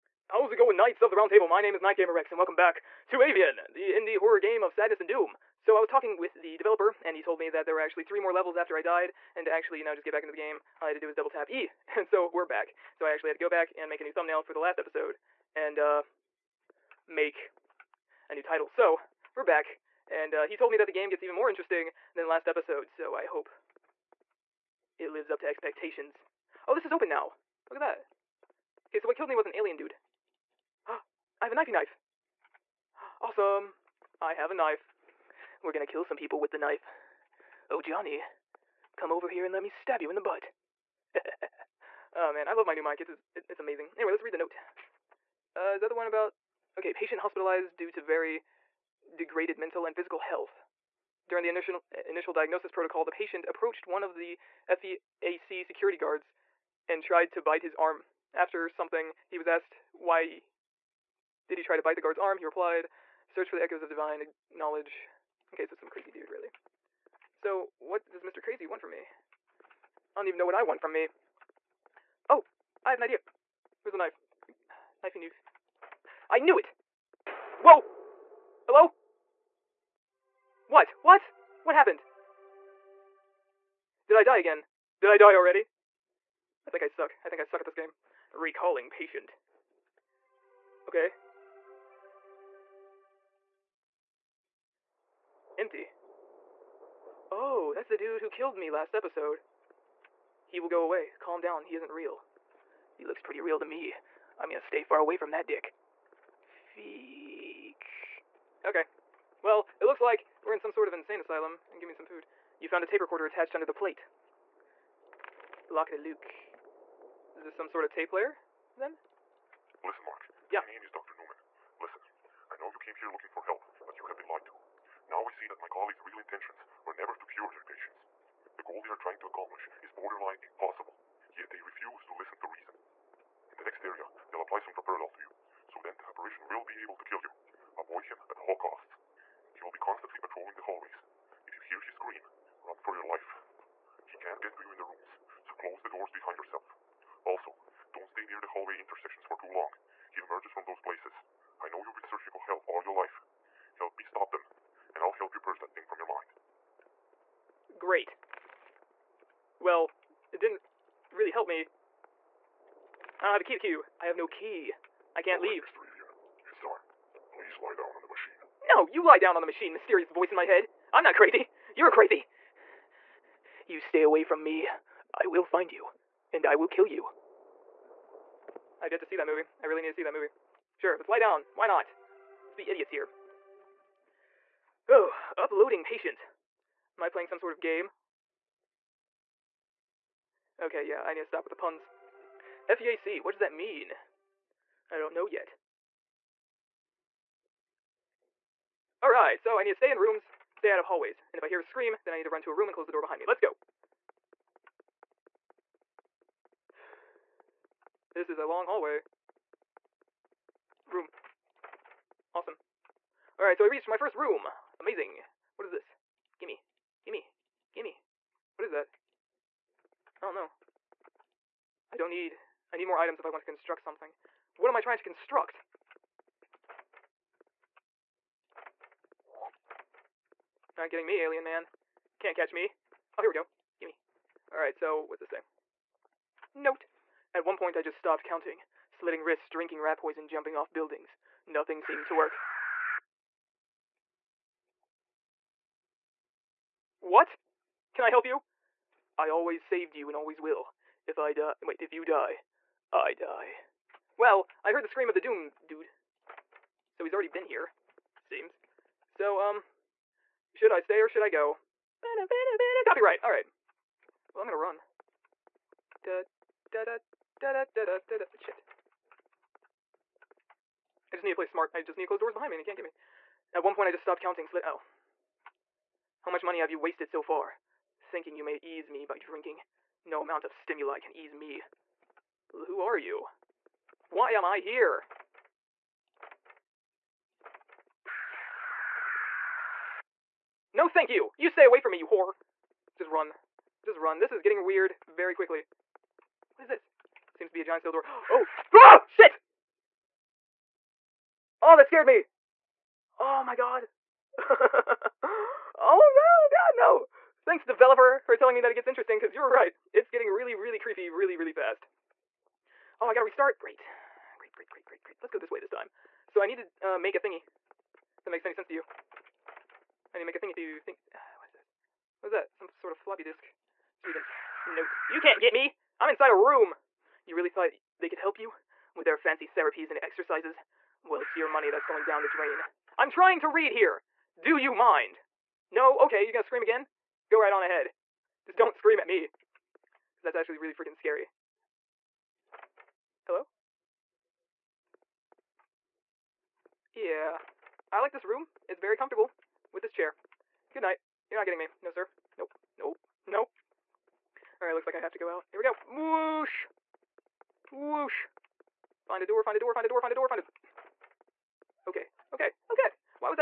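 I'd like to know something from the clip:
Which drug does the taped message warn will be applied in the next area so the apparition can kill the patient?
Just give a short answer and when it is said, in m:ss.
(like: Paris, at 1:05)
Droperidol, at 2:14.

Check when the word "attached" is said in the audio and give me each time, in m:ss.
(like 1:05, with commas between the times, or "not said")
1:53.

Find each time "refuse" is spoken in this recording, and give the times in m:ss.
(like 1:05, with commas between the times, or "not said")
2:11.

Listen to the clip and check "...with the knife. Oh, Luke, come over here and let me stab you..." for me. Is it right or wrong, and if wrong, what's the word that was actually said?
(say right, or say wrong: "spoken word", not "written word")
wrong: "Johnny", not "Luke".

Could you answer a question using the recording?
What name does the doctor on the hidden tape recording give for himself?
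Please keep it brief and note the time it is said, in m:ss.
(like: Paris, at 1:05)
Dr. Newman, at 2:00.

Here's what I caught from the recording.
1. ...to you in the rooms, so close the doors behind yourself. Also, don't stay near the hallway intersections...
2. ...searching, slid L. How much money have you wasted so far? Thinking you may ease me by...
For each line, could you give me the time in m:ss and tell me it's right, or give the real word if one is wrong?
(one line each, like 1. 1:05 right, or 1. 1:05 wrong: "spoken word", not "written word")
1. 2:24 right
2. 4:34 wrong: "counting", not "searching".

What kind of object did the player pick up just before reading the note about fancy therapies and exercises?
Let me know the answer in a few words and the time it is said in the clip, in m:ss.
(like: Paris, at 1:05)
Floppy disk, at 5:22.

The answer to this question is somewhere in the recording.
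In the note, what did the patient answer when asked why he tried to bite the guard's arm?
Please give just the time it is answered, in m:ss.
1:03.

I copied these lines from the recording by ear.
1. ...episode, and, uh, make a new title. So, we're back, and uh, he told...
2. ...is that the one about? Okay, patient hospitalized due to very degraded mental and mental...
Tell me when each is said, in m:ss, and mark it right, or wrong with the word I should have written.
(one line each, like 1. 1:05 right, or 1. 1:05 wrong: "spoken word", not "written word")
1. 0:14 right
2. 0:45 wrong: "physical", not "mental".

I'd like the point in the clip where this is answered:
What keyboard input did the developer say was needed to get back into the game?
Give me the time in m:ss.
0:11.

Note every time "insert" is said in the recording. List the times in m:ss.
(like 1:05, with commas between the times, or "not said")
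not said.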